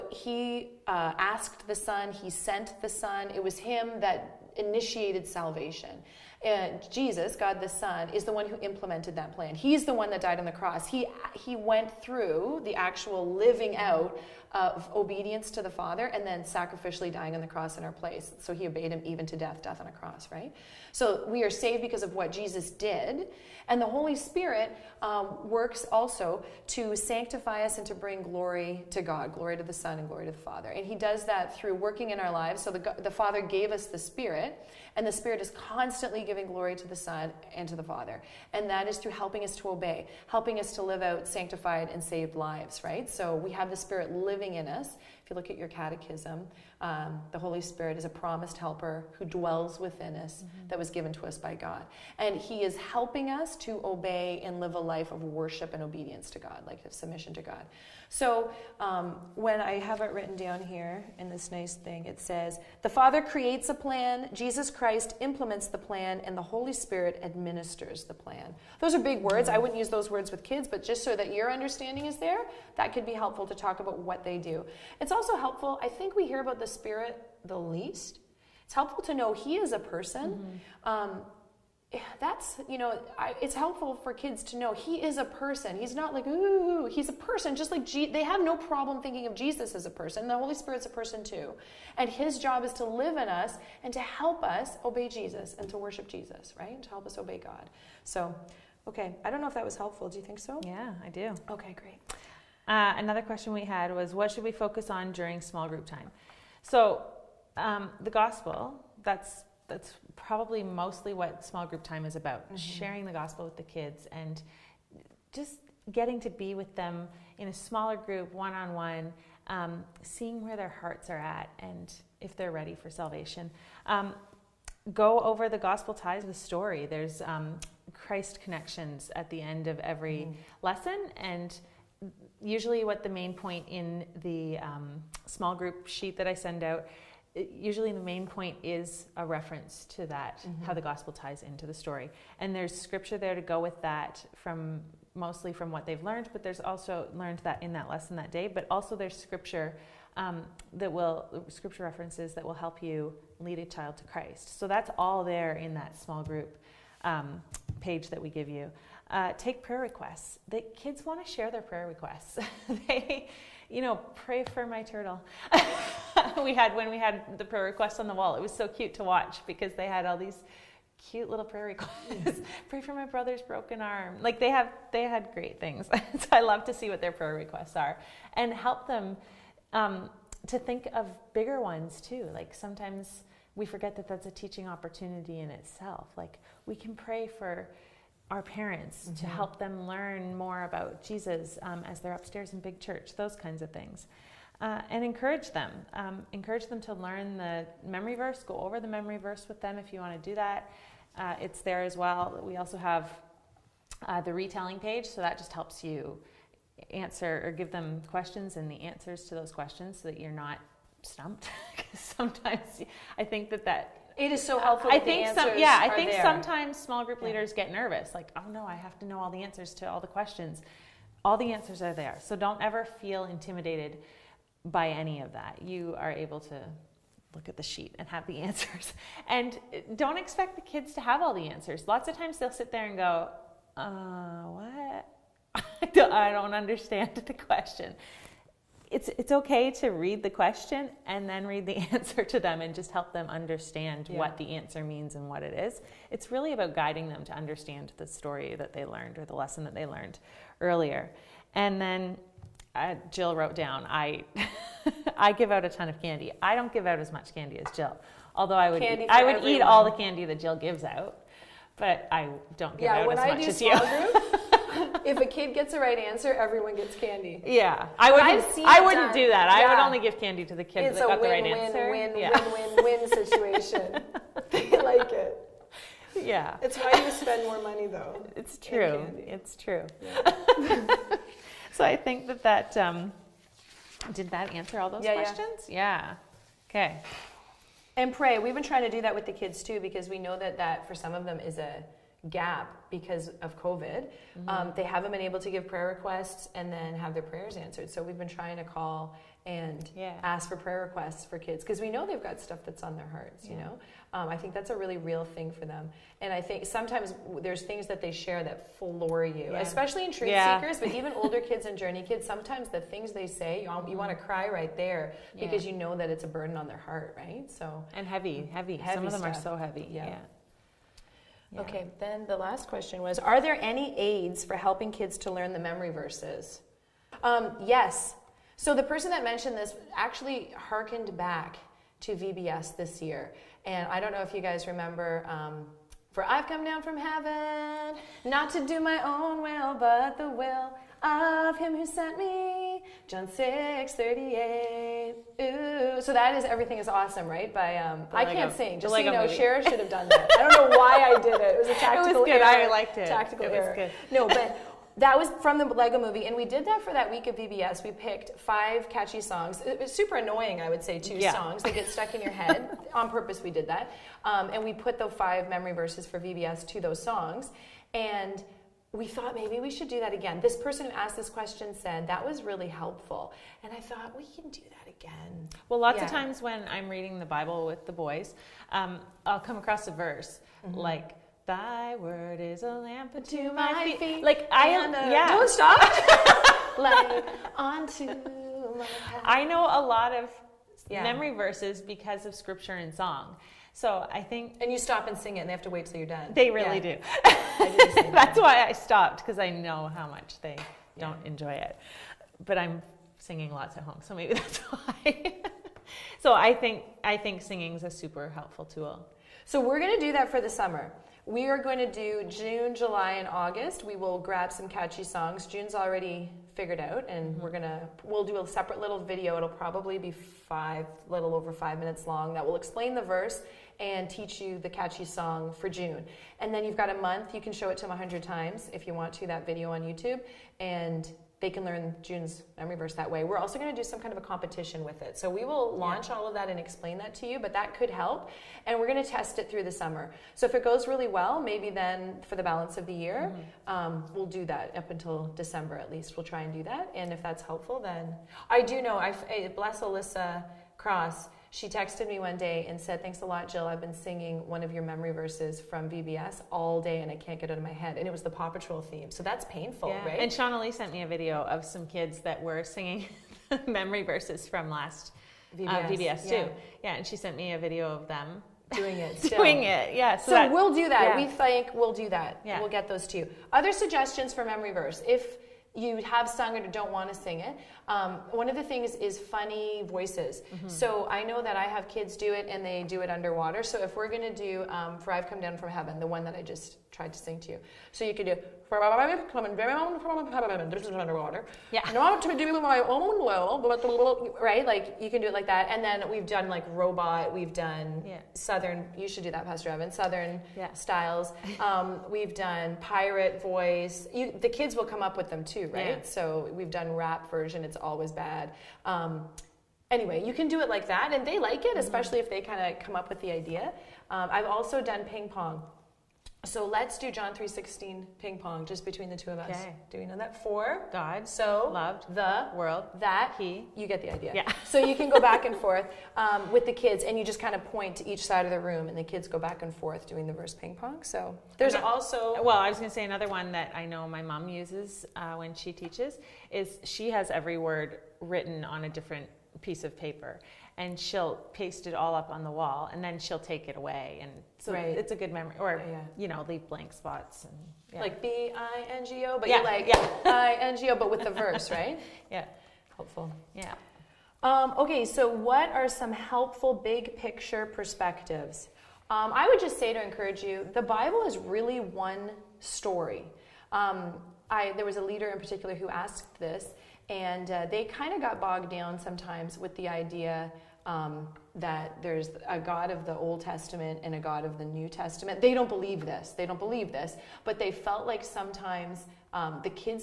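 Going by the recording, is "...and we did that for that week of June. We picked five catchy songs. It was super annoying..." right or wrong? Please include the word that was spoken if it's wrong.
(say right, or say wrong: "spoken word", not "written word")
wrong: "VBS", not "June".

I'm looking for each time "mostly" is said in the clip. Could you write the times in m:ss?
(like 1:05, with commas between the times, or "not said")
1:50, 2:25.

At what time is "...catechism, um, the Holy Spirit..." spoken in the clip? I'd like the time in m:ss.
0:45.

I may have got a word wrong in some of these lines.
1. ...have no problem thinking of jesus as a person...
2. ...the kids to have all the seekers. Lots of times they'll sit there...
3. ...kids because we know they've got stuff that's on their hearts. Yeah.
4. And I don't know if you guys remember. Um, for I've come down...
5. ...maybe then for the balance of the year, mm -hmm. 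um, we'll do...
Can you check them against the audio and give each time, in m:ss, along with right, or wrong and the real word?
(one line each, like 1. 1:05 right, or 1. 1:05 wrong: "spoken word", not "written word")
1. 1:28 right
2. 3:50 wrong: "answers", not "seekers"
3. 5:01 right
4. 5:33 right
5. 7:21 right.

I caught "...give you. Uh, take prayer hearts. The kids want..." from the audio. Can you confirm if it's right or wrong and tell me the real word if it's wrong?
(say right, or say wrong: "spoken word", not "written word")
wrong: "requests", not "hearts".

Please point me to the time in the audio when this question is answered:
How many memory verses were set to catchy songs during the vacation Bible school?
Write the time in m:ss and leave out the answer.
6:05.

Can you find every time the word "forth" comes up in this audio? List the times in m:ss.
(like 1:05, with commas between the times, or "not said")
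8:45, 8:49.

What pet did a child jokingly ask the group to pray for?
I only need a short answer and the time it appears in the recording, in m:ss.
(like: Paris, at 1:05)
Turtle, at 2:44.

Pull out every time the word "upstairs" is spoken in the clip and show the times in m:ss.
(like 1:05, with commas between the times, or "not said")
3:12.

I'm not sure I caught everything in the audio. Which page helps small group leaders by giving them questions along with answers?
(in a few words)
The retelling page.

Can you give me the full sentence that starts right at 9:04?
it's a good memory or yeah.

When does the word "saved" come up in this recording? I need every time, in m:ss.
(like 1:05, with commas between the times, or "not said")
0:21, 0:41.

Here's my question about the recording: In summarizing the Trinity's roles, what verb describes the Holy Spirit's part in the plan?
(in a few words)
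Administers.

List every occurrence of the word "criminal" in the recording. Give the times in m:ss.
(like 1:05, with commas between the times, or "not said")
not said.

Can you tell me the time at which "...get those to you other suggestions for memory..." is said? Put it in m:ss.
7:52.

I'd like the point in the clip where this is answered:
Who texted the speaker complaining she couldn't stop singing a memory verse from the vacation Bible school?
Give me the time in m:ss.
7:29.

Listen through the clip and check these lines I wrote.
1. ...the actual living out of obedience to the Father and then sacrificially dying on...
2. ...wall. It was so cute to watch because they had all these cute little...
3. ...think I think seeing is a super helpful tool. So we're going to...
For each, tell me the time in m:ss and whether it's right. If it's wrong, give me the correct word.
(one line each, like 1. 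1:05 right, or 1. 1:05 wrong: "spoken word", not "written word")
1. 0:12 right
2. 2:48 right
3. 6:46 wrong: "singing", not "seeing".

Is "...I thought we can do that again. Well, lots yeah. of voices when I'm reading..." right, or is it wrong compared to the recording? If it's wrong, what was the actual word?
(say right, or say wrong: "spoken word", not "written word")
wrong: "times", not "voices".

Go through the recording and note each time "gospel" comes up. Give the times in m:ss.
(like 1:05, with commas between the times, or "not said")
1:48, 1:53, 2:05, 2:20.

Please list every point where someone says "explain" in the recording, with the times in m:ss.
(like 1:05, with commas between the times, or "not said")
7:02, 7:16.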